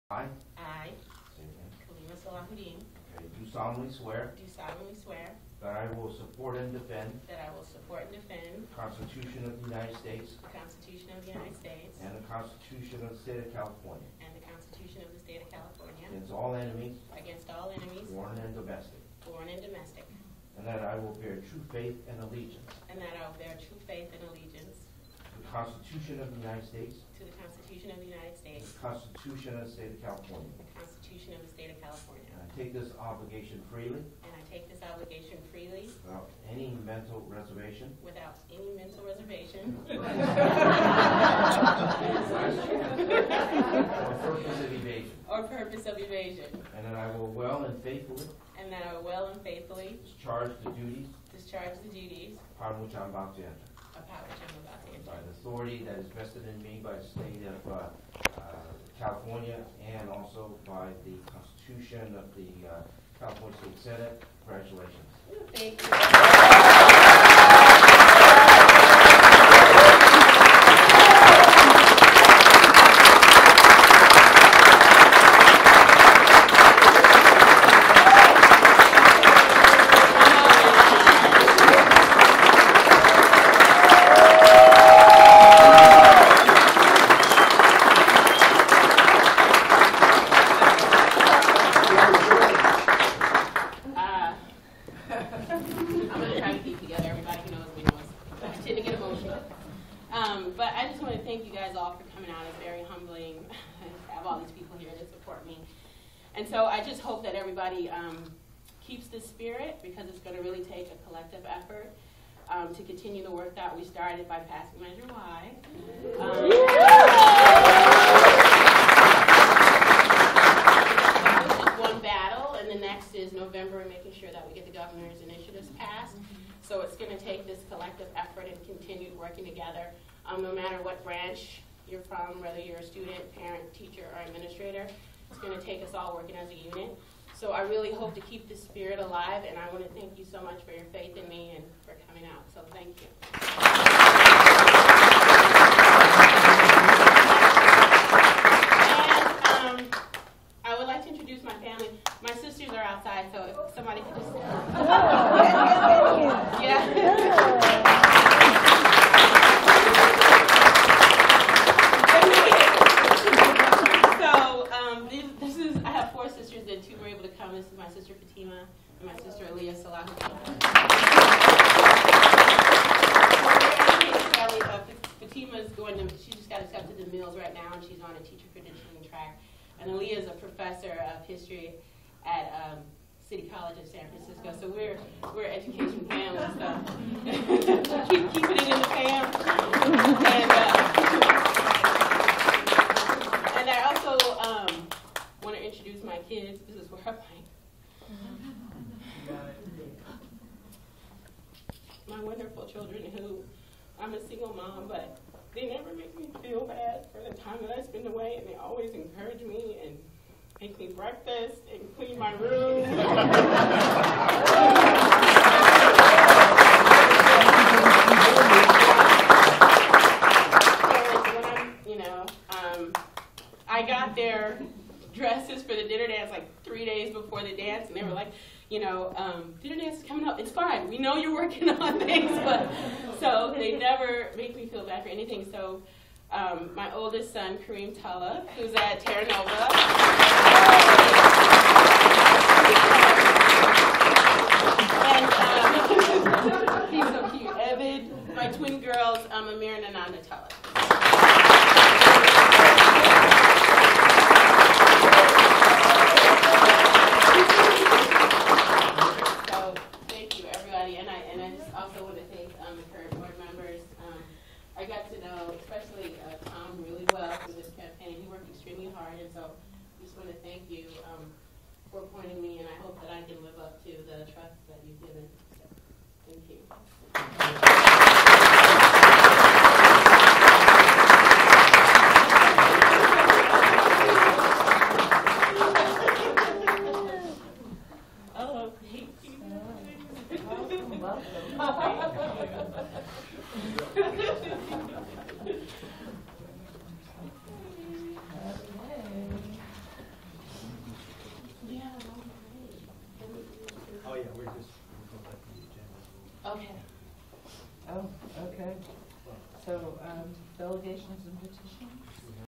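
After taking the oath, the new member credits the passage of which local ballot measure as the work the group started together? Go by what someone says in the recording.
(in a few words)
Measure Y.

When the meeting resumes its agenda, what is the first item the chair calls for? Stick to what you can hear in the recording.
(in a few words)
Delegations and petitions.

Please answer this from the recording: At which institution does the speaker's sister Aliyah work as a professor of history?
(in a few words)
City College of San Francisco.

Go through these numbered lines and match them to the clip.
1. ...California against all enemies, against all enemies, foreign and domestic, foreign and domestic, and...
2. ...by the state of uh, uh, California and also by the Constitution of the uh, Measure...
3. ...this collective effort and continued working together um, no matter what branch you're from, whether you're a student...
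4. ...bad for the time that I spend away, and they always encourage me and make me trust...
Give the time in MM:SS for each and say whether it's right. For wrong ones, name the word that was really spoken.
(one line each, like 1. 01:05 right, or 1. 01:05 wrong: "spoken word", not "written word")
1. 00:15 right
2. 00:56 wrong: "California", not "Measure"
3. 02:07 right
4. 03:26 wrong: "breakfast", not "trust".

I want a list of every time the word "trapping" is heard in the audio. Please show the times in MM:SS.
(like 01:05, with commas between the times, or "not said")
not said.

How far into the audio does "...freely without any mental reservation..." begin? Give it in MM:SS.
00:35.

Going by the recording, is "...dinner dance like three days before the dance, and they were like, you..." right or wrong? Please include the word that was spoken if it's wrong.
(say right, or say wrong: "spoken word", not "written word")
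right.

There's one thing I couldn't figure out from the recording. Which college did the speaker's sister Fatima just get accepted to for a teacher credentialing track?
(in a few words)
Mills.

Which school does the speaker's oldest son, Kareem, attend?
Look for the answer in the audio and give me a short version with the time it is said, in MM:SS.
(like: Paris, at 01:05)
Terra Nova, at 03:59.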